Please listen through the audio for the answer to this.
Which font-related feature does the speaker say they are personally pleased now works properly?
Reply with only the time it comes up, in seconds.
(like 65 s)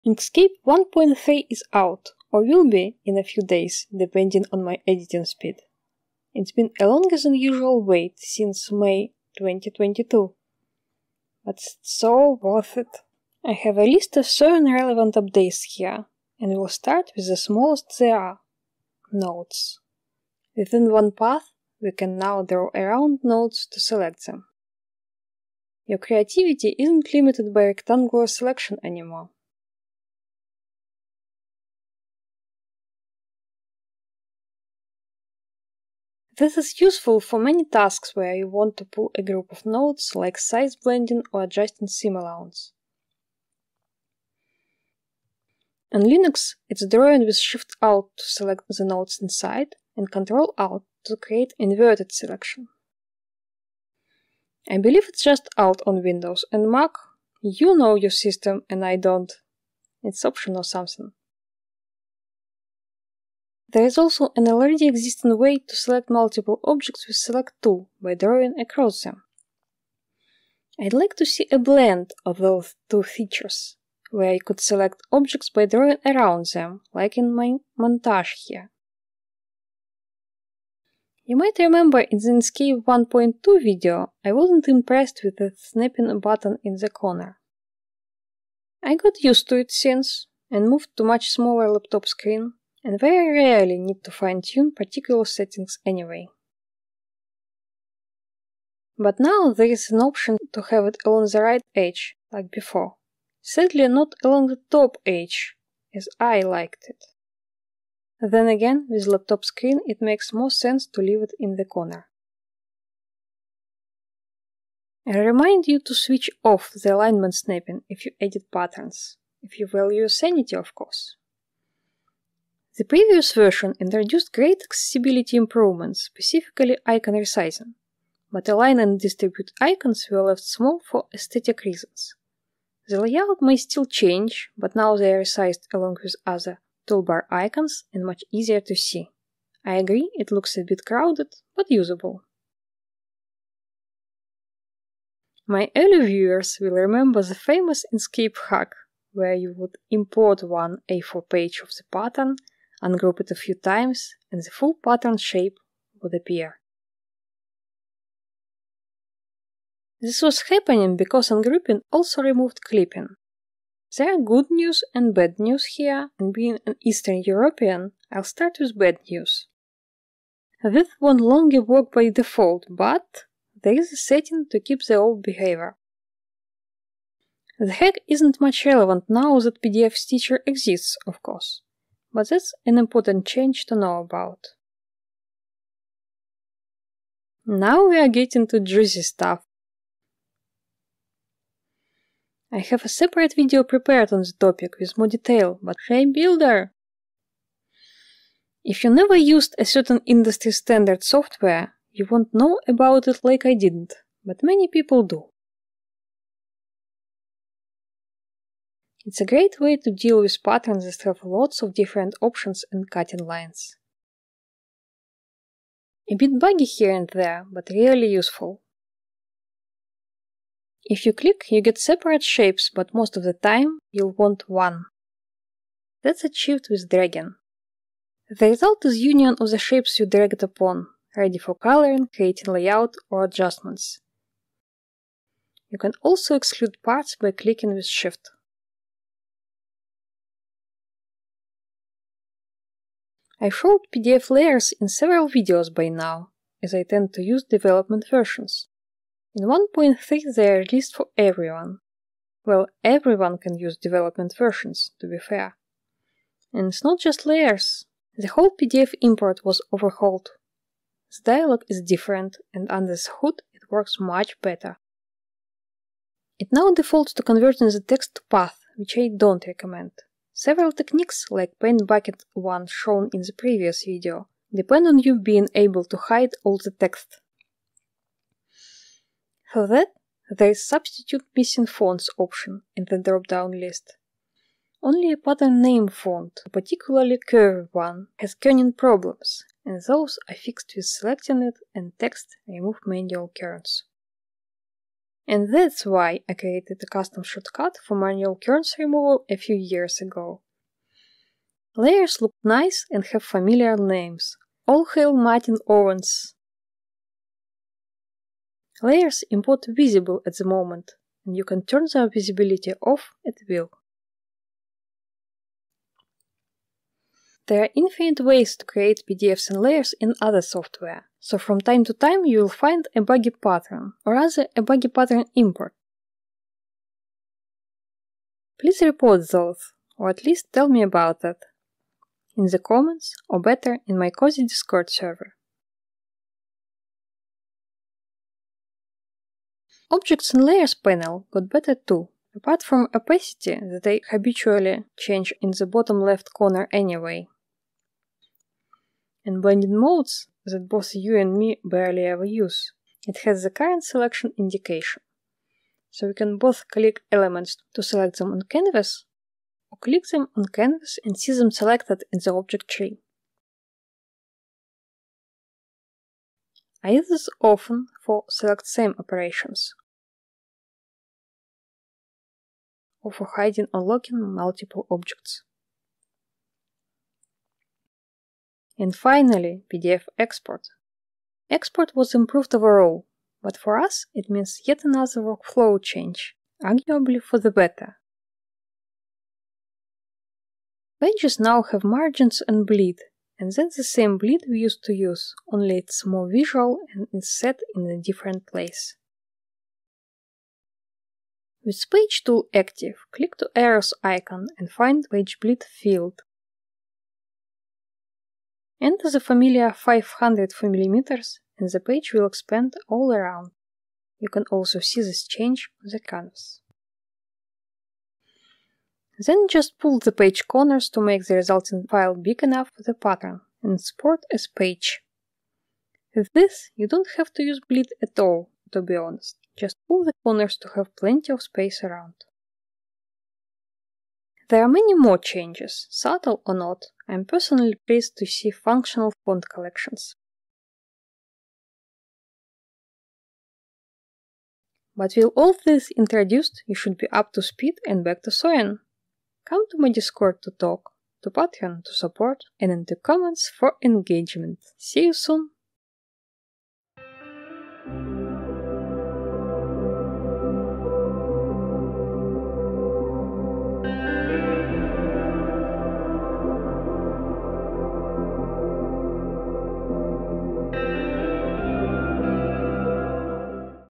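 439 s.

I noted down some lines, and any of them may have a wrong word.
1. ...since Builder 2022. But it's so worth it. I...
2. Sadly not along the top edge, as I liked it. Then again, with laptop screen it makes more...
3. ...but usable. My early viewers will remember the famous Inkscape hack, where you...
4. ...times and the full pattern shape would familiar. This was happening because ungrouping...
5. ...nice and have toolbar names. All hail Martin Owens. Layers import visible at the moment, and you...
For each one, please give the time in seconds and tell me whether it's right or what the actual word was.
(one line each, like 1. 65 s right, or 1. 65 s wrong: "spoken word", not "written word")
1. 8 s wrong: "May", not "Builder"
2. 103 s right
3. 141 s right
4. 153 s wrong: "appear", not "familiar"
5. 302 s wrong: "familiar", not "toolbar".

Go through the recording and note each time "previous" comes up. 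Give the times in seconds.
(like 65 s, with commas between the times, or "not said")
122 s, 273 s.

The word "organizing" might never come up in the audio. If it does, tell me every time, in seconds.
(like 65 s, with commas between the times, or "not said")
not said.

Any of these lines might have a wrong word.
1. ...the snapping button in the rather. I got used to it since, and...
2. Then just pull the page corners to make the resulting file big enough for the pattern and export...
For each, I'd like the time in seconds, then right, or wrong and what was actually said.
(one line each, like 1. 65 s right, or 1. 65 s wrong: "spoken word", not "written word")
1. 85 s wrong: "corner", not "rather"
2. 419 s right.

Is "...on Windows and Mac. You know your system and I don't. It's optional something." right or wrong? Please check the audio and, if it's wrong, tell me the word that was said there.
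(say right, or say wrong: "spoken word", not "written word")
right.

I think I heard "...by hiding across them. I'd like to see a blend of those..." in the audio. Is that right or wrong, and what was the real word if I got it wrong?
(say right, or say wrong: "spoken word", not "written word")
wrong: "drawing", not "hiding".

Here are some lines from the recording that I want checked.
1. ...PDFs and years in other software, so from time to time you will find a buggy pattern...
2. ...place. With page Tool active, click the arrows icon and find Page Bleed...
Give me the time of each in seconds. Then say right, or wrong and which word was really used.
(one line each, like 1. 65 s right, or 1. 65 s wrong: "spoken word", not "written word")
1. 319 s wrong: "layers", not "years"
2. 398 s right.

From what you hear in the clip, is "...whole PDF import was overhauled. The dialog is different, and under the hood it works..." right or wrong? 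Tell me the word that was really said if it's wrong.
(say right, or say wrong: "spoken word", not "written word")
right.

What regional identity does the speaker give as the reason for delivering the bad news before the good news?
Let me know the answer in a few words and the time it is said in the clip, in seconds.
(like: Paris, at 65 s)
Eastern European, at 166 s.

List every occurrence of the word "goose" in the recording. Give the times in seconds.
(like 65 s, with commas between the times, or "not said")
not said.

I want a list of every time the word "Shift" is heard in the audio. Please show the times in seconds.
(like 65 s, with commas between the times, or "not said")
47 s, 237 s.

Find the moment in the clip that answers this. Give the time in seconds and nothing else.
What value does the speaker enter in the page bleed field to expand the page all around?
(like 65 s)
409 s.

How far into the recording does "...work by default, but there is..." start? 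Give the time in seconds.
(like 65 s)
171 s.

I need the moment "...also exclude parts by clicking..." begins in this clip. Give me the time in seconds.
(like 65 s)
236 s.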